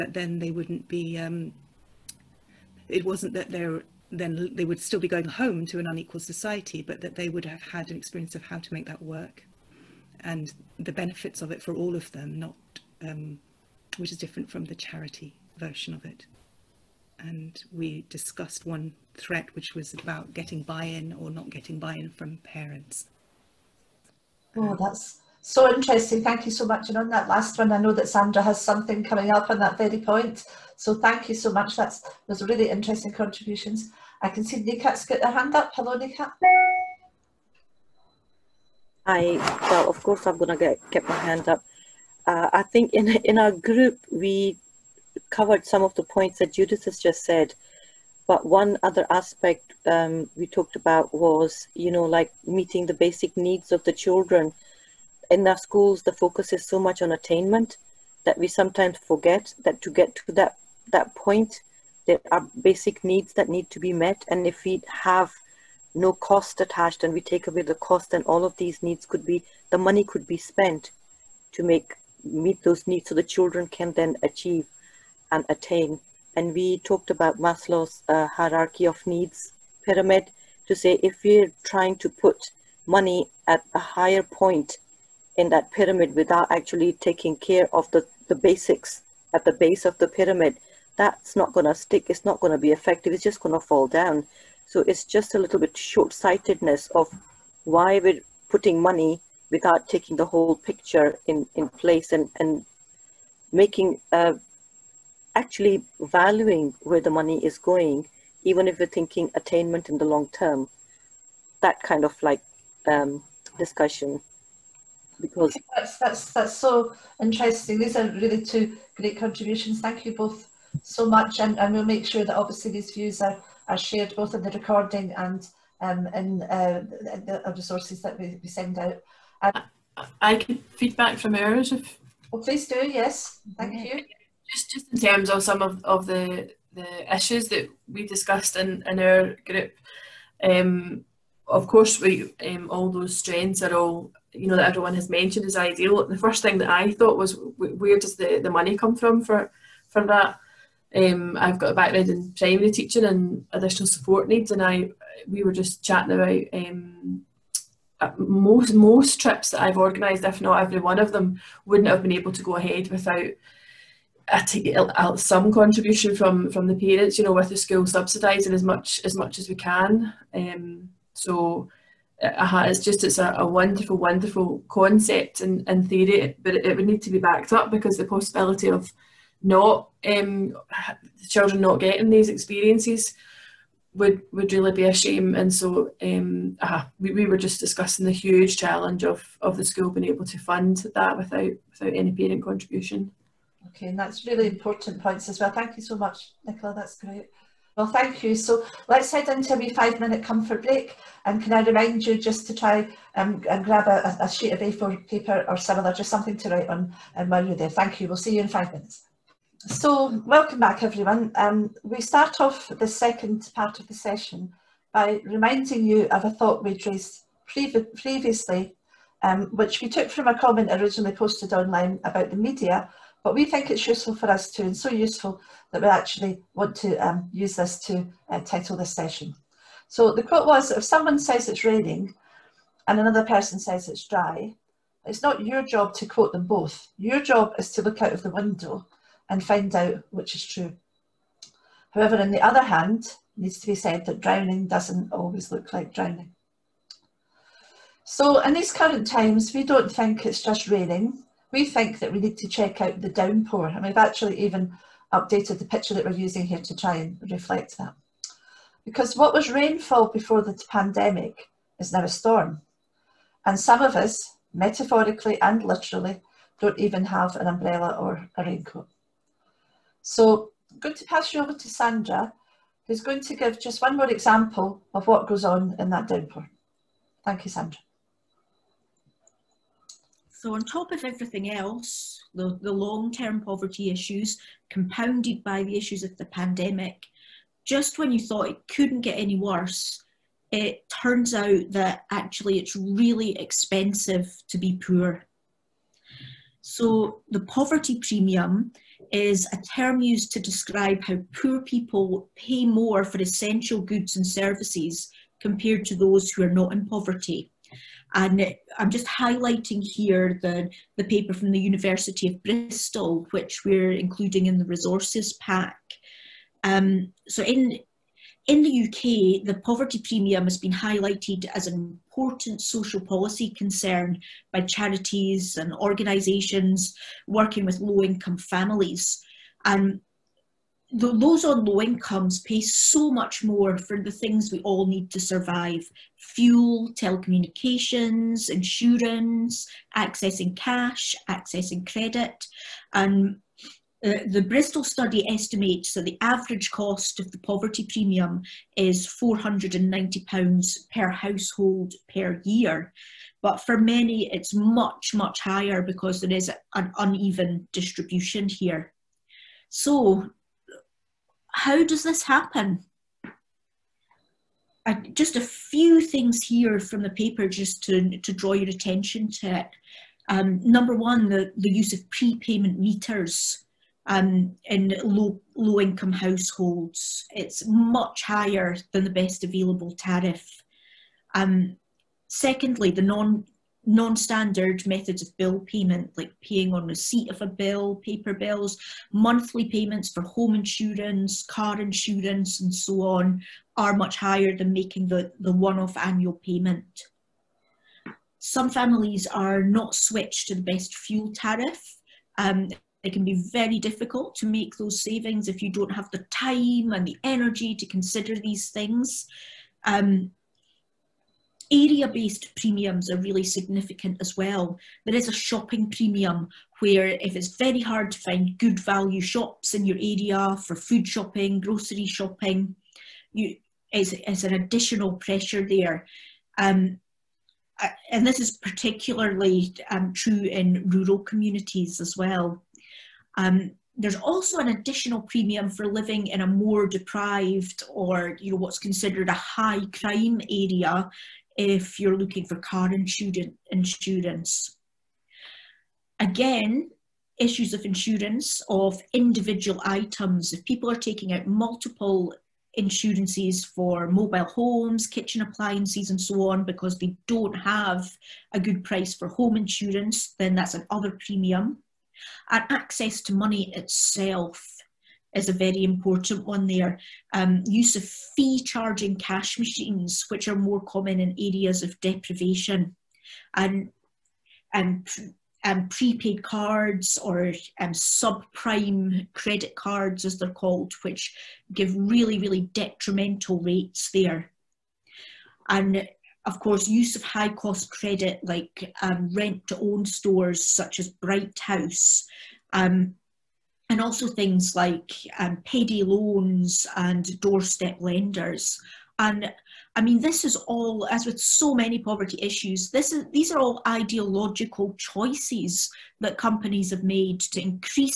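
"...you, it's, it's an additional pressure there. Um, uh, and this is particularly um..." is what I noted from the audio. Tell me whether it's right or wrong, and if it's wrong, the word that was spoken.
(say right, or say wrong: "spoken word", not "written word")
right.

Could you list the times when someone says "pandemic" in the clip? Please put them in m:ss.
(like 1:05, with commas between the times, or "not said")
4:20, 4:46.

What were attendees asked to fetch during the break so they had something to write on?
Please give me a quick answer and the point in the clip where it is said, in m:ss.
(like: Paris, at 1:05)
A4 paper, at 3:24.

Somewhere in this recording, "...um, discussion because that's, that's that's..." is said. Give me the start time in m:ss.
1:52.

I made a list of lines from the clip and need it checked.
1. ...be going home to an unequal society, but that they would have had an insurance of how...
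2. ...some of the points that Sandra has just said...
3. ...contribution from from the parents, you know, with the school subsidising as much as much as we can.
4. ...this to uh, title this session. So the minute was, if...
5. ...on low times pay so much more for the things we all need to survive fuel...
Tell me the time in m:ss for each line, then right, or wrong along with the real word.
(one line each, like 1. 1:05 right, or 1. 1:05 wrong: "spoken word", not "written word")
1. 0:04 wrong: "experience", not "insurance"
2. 0:45 wrong: "Judith", not "Sandra"
3. 2:45 right
4. 3:47 wrong: "quote", not "minute"
5. 5:31 wrong: "incomes", not "times".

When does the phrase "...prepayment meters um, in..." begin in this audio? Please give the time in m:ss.
6:12.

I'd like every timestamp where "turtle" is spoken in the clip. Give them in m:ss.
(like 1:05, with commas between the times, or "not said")
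not said.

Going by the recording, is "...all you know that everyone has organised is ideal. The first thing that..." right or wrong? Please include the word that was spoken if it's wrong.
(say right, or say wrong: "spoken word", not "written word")
wrong: "mentioned", not "organised".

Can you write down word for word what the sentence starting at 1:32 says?
It's not going to be effective.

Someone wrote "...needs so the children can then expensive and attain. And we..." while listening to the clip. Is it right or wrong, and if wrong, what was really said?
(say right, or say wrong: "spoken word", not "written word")
wrong: "achieve", not "expensive".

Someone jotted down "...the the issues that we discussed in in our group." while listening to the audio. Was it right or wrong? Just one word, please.
right.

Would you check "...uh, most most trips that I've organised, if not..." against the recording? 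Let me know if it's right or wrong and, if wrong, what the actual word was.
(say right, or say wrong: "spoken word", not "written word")
right.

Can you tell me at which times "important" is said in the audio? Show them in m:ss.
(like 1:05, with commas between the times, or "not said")
3:14, 5:22, 7:45.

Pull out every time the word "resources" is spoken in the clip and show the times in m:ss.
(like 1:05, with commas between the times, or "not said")
2:07, 5:14.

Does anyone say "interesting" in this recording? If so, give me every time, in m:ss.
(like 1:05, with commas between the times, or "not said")
0:25, 0:32, 1:57.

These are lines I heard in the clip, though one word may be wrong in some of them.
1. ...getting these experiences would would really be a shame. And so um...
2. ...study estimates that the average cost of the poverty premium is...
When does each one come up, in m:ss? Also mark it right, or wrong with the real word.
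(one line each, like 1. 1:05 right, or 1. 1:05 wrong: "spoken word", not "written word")
1. 3:01 right
2. 5:44 right.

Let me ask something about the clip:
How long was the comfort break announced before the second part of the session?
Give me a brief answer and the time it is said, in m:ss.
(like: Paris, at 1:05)
5 minutes, at 3:19.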